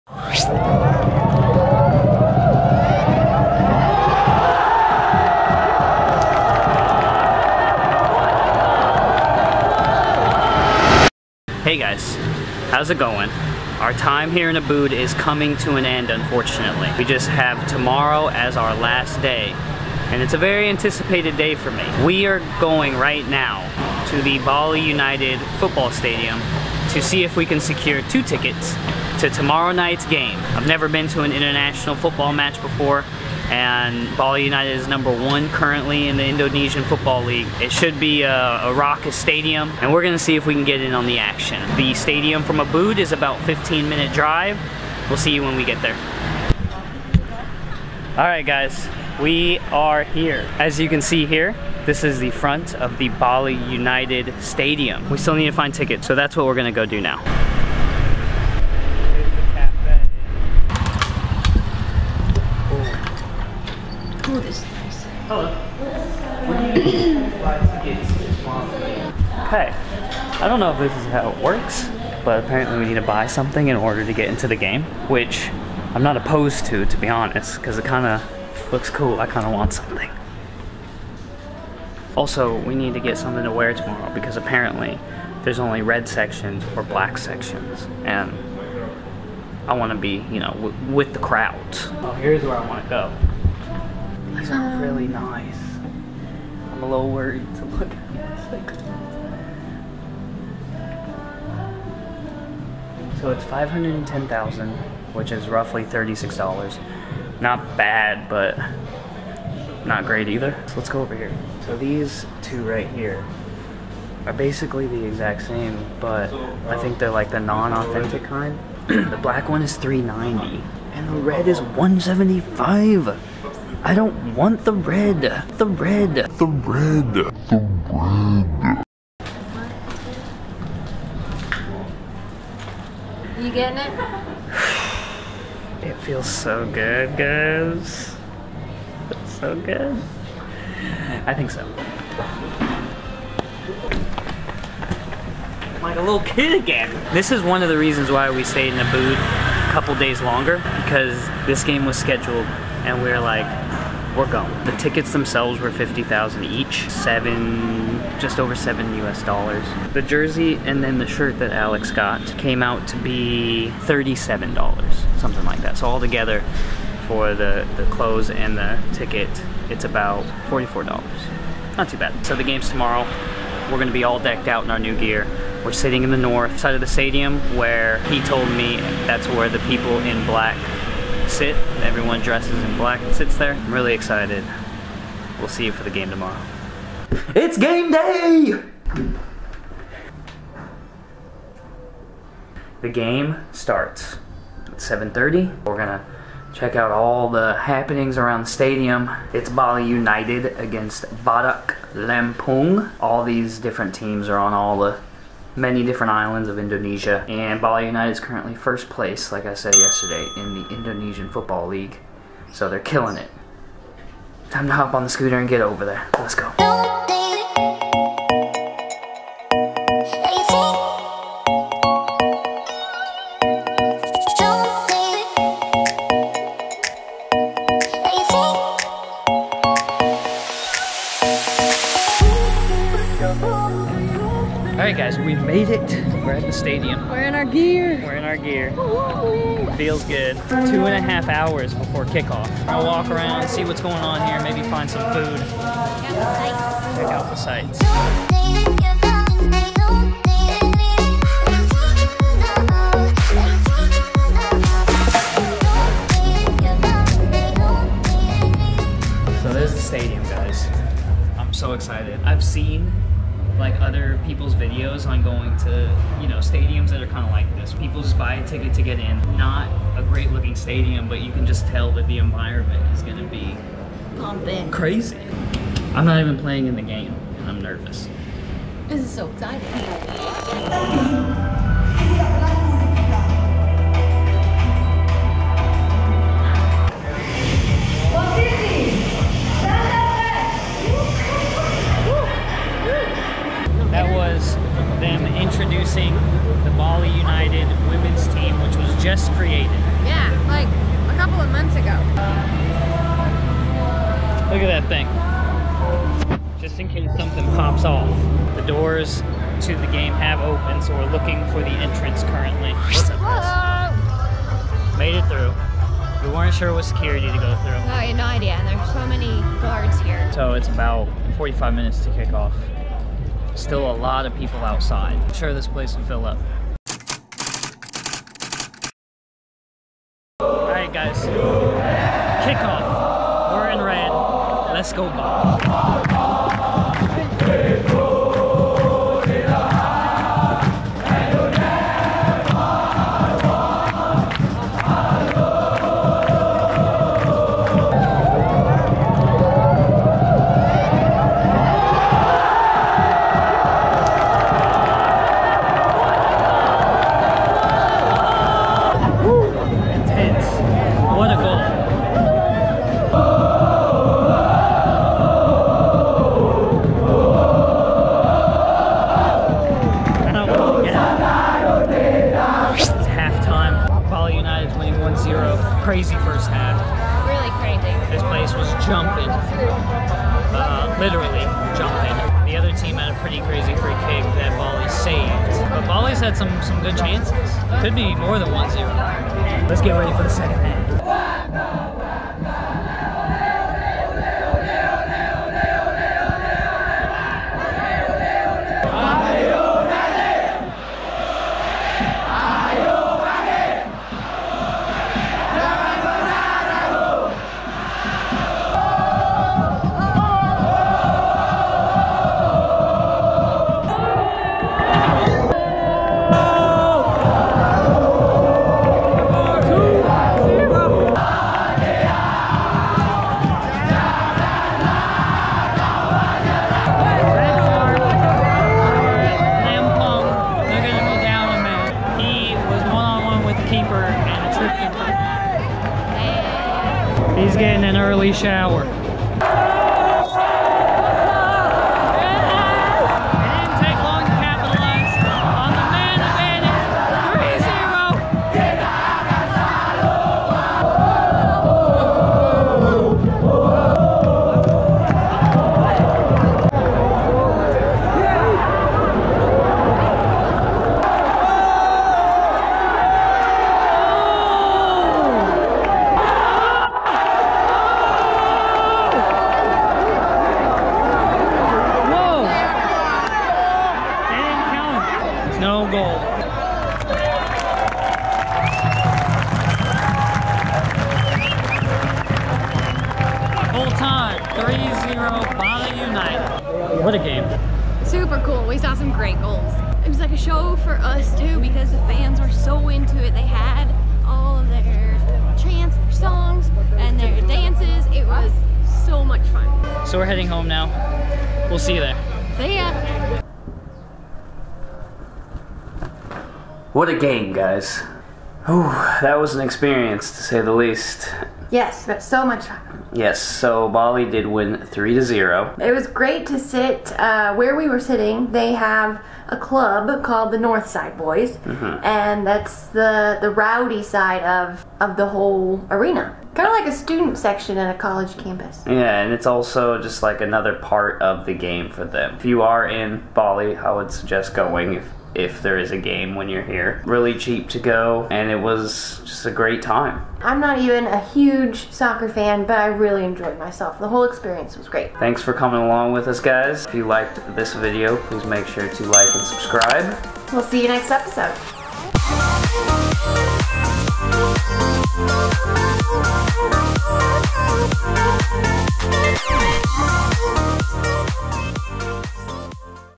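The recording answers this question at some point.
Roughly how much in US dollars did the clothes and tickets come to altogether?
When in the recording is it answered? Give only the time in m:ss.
2:49.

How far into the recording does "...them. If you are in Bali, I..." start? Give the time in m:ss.
8:52.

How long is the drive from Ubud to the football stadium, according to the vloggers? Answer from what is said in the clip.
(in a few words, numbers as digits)
15 minutes.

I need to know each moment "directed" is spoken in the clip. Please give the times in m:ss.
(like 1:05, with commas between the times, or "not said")
not said.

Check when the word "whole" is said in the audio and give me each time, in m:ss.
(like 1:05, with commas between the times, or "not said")
8:45, 9:04.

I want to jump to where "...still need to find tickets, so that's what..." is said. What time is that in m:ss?
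0:55.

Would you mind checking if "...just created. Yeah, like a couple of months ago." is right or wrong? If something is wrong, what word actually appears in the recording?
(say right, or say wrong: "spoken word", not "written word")
right.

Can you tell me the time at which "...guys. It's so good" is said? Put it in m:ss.
2:17.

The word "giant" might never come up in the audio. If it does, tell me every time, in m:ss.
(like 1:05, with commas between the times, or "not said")
not said.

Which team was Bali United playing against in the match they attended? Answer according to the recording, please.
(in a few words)
Badak Lampung.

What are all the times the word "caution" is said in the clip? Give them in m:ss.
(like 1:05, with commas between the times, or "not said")
not said.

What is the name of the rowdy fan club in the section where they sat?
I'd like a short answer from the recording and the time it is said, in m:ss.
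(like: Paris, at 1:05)
North Side Boys, at 8:40.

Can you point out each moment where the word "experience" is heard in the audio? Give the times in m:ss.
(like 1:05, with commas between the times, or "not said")
8:29, 9:04.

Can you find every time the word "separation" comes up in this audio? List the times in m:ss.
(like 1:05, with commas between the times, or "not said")
not said.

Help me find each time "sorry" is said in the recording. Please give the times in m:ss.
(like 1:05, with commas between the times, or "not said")
not said.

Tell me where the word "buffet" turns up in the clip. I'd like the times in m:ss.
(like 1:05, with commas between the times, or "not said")
not said.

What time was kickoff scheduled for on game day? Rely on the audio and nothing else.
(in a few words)
7:30.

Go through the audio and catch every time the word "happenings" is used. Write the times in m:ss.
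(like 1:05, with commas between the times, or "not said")
3:17.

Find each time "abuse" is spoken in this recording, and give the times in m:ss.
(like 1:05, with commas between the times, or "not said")
not said.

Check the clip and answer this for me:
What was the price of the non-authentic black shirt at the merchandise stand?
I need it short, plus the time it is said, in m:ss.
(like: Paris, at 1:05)
390, at 1:58.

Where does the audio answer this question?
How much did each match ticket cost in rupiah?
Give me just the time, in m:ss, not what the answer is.
2:35.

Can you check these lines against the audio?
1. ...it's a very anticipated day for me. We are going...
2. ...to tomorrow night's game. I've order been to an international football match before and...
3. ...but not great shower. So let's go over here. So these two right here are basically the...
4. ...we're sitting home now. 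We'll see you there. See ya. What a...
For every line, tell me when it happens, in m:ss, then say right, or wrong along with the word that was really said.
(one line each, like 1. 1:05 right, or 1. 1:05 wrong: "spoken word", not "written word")
1. 0:20 right
2. 0:29 wrong: "never", not "order"
3. 1:48 wrong: "either", not "shower"
4. 8:20 wrong: "heading", not "sitting".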